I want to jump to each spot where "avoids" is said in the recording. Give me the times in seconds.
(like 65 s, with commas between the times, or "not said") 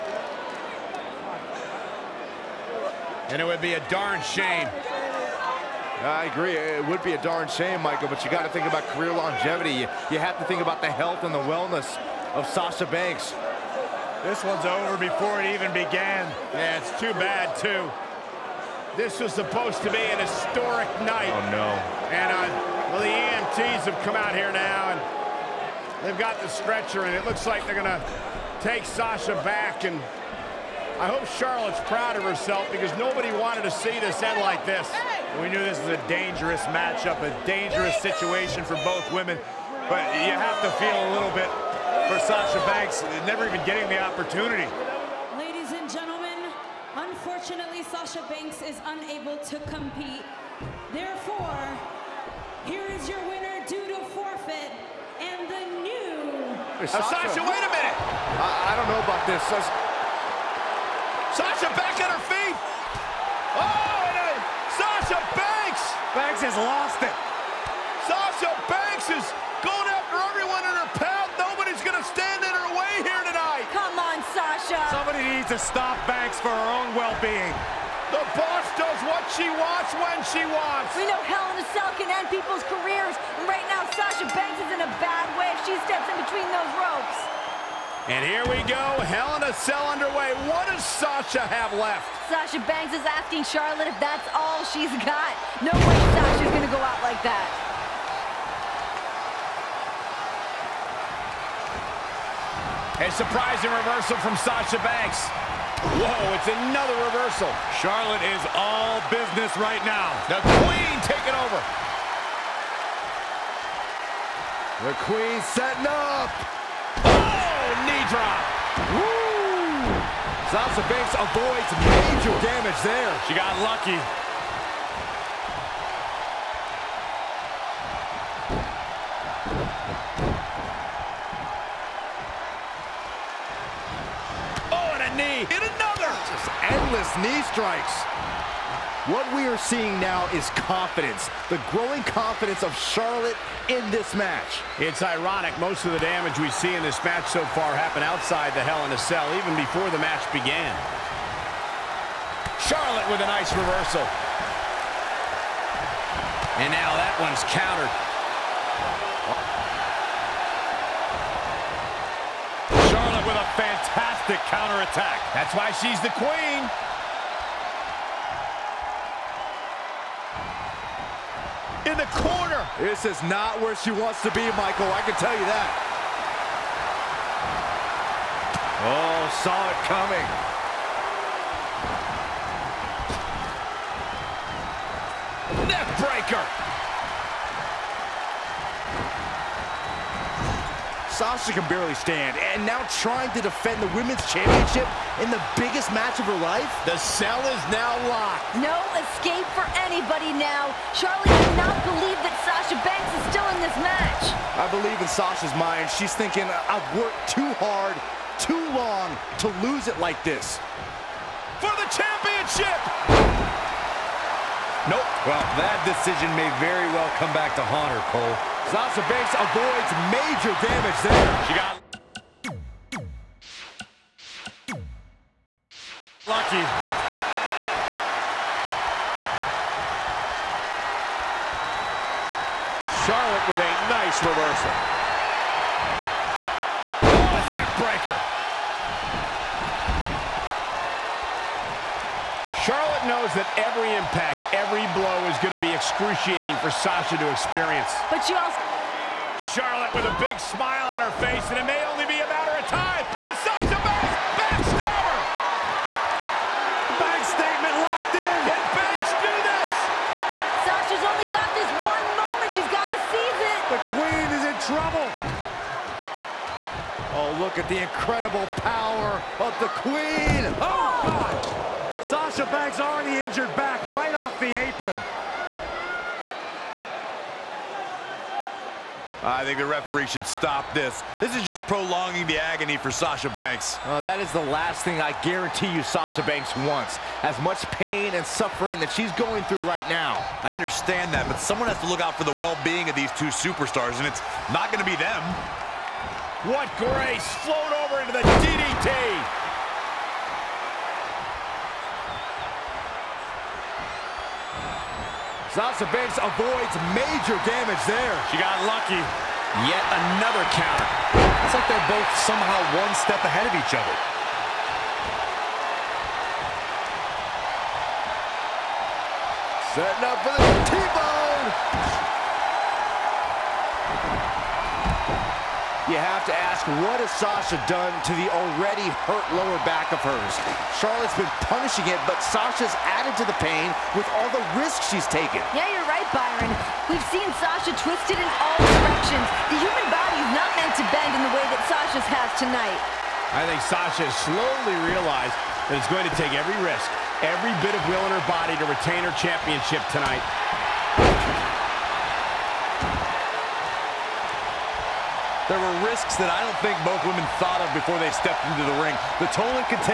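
121 s, 219 s, 306 s.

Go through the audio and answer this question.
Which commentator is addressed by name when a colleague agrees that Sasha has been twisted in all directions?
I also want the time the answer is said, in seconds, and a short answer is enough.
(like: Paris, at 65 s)
Byron, at 336 s.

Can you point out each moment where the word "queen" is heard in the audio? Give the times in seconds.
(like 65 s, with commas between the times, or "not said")
110 s, 115 s, 166 s, 269 s.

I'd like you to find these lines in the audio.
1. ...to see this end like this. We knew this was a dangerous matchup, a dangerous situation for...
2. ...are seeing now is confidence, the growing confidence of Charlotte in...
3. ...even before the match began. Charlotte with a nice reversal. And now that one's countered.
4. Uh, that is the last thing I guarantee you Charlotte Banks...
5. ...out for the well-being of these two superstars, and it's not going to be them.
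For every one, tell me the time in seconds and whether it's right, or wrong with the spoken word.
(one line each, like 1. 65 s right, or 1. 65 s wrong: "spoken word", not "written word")
1. 33 s right
2. 139 s right
3. 149 s right
4. 283 s wrong: "Sasha", not "Charlotte"
5. 291 s right.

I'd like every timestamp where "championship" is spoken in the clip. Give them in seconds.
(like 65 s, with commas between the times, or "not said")
194 s, 211 s, 349 s.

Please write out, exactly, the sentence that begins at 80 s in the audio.
We know Hell in a Cell can end people's careers.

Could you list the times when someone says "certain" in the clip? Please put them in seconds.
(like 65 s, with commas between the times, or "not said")
not said.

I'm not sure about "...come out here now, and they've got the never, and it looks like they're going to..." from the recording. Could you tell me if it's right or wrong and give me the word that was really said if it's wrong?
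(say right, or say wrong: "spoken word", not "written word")
wrong: "stretcher", not "never".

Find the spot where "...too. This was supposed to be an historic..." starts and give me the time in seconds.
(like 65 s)
17 s.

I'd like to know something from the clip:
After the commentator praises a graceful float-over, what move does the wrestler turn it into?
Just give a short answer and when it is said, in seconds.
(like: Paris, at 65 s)
DDT, at 298 s.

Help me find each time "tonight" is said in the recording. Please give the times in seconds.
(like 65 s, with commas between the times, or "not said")
73 s, 342 s, 349 s.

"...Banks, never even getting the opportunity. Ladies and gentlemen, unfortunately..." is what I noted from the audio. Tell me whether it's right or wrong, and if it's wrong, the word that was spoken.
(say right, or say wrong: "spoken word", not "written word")
right.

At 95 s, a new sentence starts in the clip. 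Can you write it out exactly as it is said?
No way Sasha's gonna go out like that.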